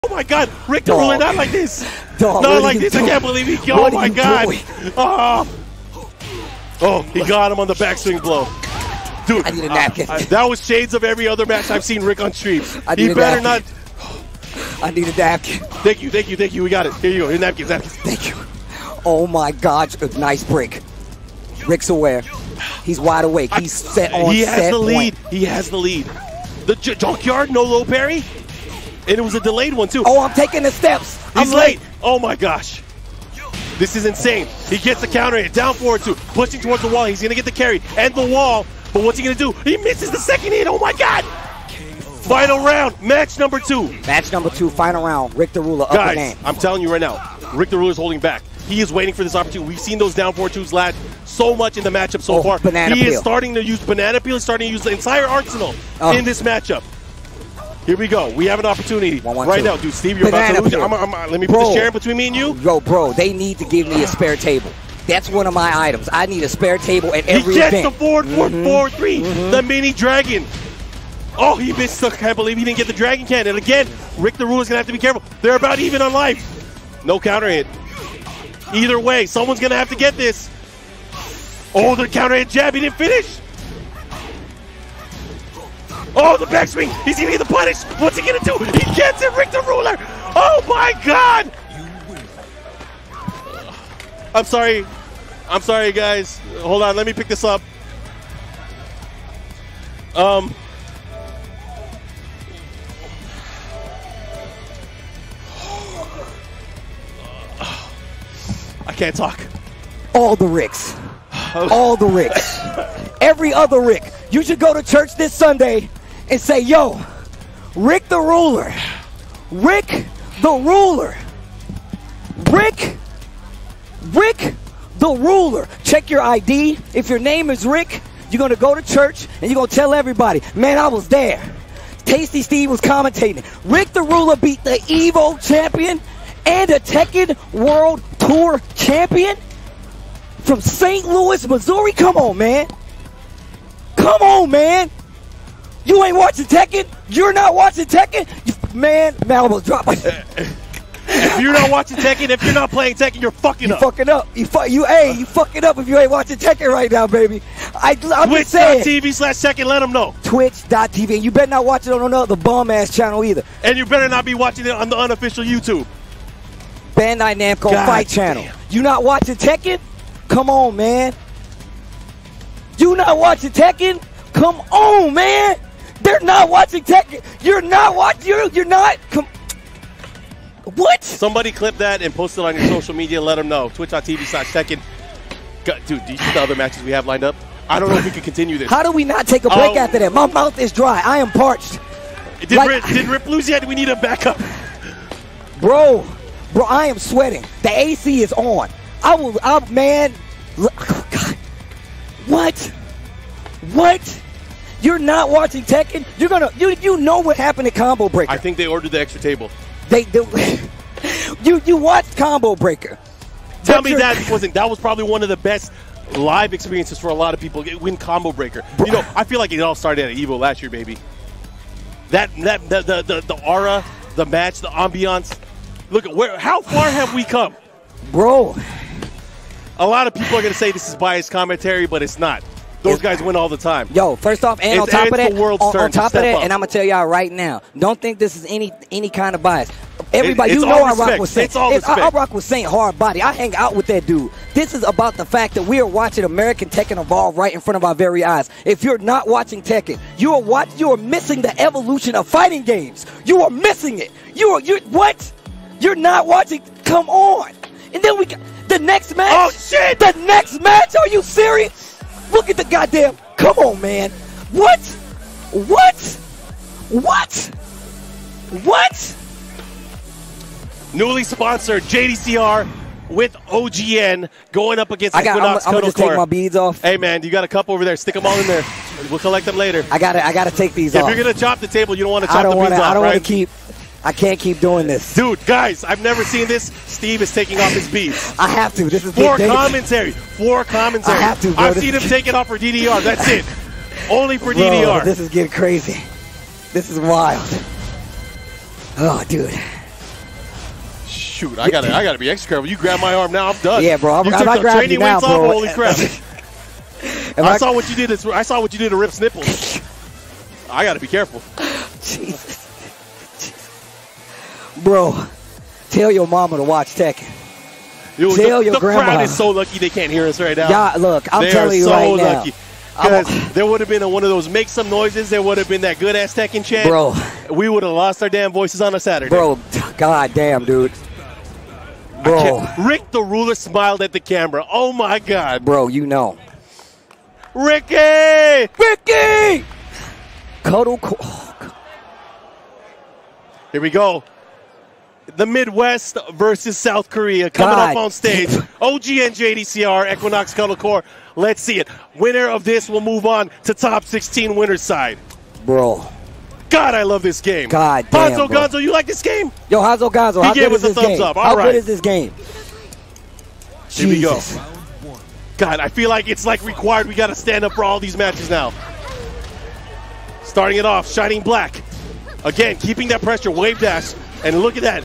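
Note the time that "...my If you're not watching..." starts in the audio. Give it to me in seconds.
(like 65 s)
149 s.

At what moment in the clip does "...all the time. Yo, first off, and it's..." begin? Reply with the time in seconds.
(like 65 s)
233 s.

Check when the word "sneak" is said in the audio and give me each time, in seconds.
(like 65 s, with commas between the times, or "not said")
not said.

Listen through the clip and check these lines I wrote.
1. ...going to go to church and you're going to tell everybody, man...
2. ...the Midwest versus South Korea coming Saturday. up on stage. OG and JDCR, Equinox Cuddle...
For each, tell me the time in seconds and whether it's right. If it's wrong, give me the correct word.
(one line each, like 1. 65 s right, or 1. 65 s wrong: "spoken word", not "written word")
1. 128 s right
2. 345 s wrong: "God", not "Saturday".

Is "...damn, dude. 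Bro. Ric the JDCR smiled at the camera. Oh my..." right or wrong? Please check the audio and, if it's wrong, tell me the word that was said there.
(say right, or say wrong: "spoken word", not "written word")
wrong: "Ruler", not "JDCR".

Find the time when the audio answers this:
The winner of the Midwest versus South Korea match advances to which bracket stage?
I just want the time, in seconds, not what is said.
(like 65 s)
353 s.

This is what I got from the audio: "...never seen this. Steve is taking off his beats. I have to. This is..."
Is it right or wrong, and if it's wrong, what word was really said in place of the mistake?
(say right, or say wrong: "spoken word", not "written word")
right.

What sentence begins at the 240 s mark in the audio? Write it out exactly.
Everybody, it, you know I rock with Saint.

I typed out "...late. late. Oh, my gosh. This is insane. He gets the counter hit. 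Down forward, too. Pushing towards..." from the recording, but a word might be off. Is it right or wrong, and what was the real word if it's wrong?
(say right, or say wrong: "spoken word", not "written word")
right.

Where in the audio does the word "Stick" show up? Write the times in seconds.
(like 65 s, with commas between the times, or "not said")
277 s.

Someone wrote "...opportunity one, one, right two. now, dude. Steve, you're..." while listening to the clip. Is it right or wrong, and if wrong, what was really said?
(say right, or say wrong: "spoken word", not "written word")
right.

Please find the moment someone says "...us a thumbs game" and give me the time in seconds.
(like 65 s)
360 s.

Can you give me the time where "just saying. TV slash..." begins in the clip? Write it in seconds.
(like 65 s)
158 s.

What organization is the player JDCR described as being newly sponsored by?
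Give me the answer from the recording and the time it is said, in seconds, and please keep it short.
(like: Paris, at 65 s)
OGN, at 273 s.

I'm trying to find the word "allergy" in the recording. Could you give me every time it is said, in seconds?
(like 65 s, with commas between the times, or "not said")
not said.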